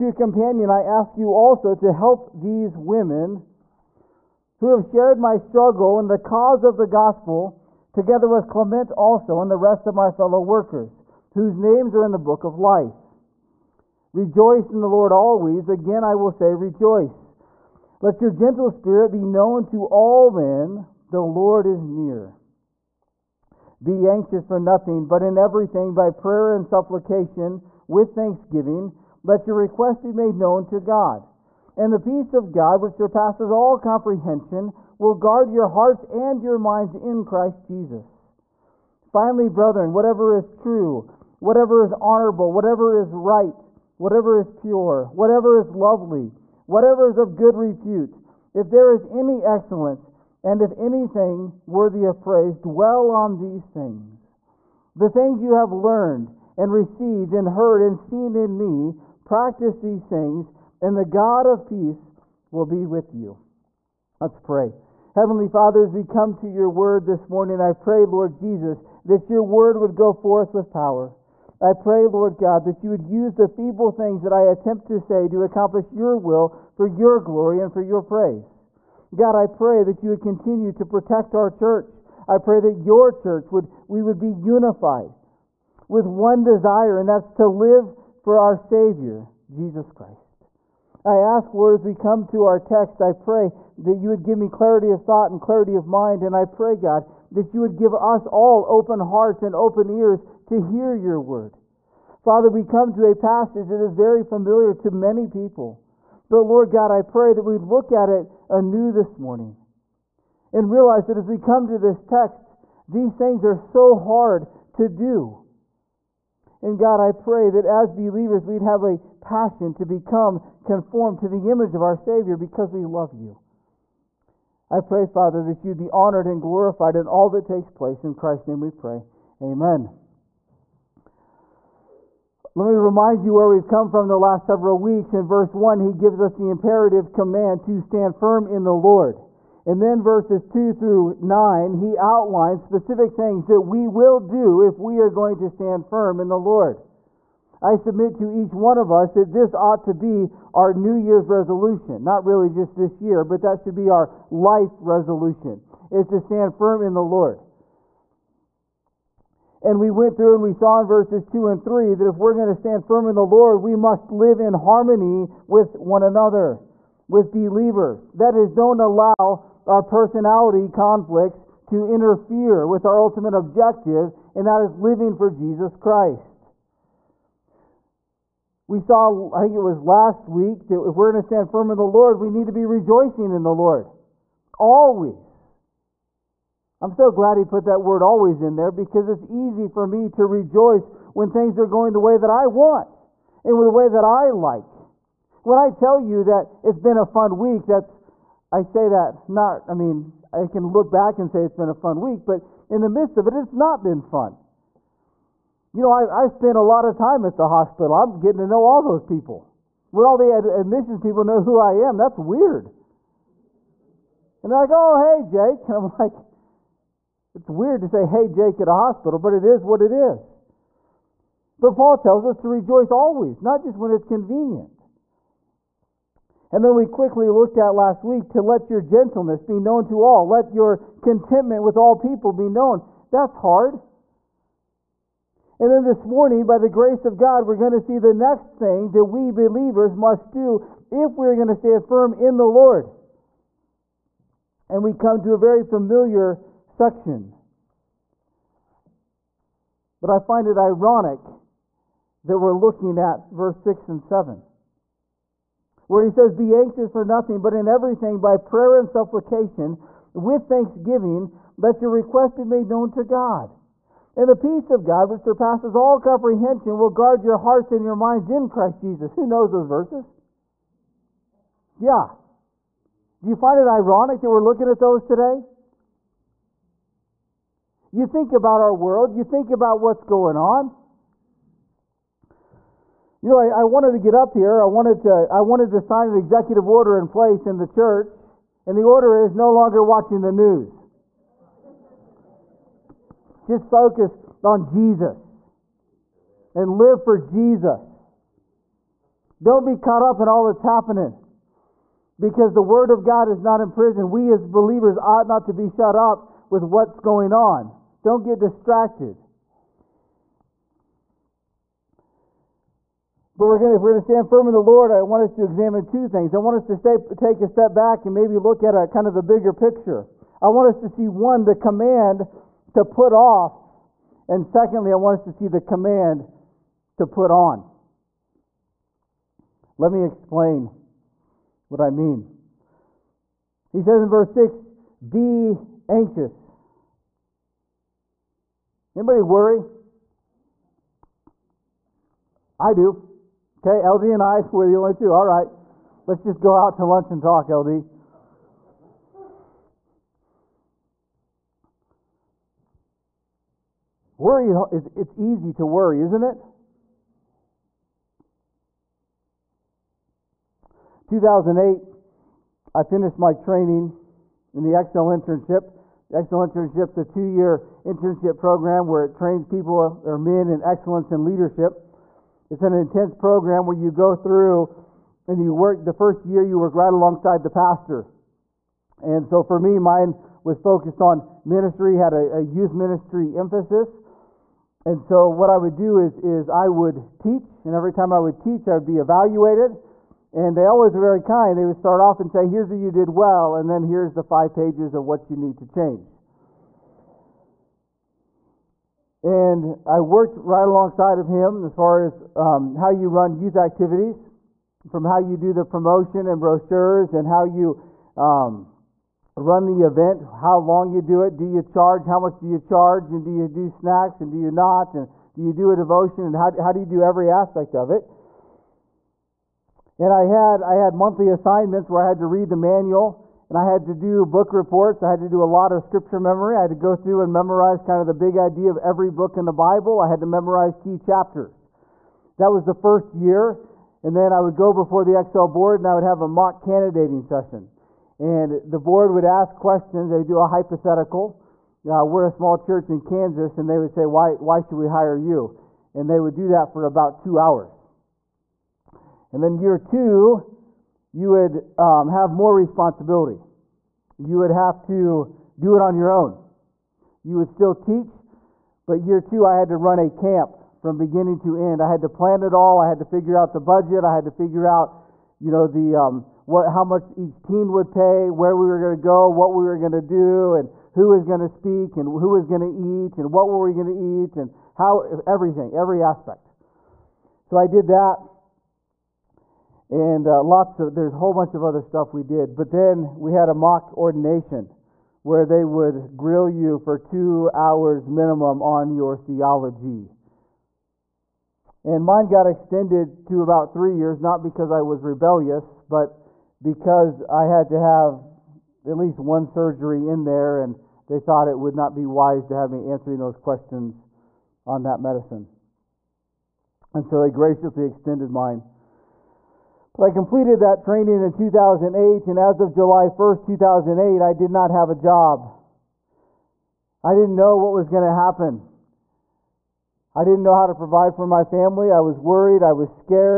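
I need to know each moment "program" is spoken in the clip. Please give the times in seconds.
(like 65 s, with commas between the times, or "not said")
368 s, 373 s.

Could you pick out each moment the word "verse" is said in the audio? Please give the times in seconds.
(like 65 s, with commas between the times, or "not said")
135 s, 140 s, 160 s, 253 s, 269 s, 334 s.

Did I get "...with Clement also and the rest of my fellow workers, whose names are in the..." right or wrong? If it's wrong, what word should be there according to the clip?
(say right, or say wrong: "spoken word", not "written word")
right.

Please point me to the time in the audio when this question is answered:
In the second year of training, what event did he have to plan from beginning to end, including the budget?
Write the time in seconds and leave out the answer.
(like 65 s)
460 s.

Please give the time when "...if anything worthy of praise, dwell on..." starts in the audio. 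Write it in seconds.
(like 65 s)
50 s.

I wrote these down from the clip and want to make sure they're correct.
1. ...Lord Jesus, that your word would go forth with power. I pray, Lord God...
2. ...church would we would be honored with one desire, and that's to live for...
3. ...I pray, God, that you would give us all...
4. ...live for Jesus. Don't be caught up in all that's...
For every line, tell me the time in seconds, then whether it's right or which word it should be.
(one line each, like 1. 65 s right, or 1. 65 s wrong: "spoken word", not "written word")
1. 68 s right
2. 83 s wrong: "unified", not "honored"
3. 96 s right
4. 296 s right.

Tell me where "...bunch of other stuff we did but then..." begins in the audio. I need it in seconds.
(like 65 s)
481 s.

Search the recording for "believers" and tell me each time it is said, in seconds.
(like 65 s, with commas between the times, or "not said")
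117 s, 167 s, 239 s, 304 s.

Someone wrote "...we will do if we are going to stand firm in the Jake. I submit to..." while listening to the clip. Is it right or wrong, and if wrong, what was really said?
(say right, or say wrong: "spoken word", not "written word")
wrong: "Lord", not "Jake".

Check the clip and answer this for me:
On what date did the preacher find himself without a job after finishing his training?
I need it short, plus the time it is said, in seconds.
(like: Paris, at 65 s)
July 1, 2008, at 512 s.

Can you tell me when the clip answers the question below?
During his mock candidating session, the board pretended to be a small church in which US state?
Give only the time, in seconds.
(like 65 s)
443 s.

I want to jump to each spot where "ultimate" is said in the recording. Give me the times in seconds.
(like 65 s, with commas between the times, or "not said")
173 s.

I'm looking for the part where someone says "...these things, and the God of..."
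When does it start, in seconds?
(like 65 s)
59 s.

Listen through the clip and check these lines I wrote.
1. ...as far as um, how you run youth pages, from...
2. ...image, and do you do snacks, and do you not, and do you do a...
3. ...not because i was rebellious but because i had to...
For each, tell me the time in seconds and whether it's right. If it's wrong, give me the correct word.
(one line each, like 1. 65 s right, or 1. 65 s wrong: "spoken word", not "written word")
1. 401 s wrong: "activities", not "pages"
2. 412 s wrong: "charge", not "image"
3. 494 s right.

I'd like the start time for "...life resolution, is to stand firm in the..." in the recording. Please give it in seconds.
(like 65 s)
154 s.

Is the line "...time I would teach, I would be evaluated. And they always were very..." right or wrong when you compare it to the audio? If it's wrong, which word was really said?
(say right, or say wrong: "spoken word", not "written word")
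right.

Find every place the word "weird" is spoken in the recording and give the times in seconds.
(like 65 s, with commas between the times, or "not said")
212 s, 217 s.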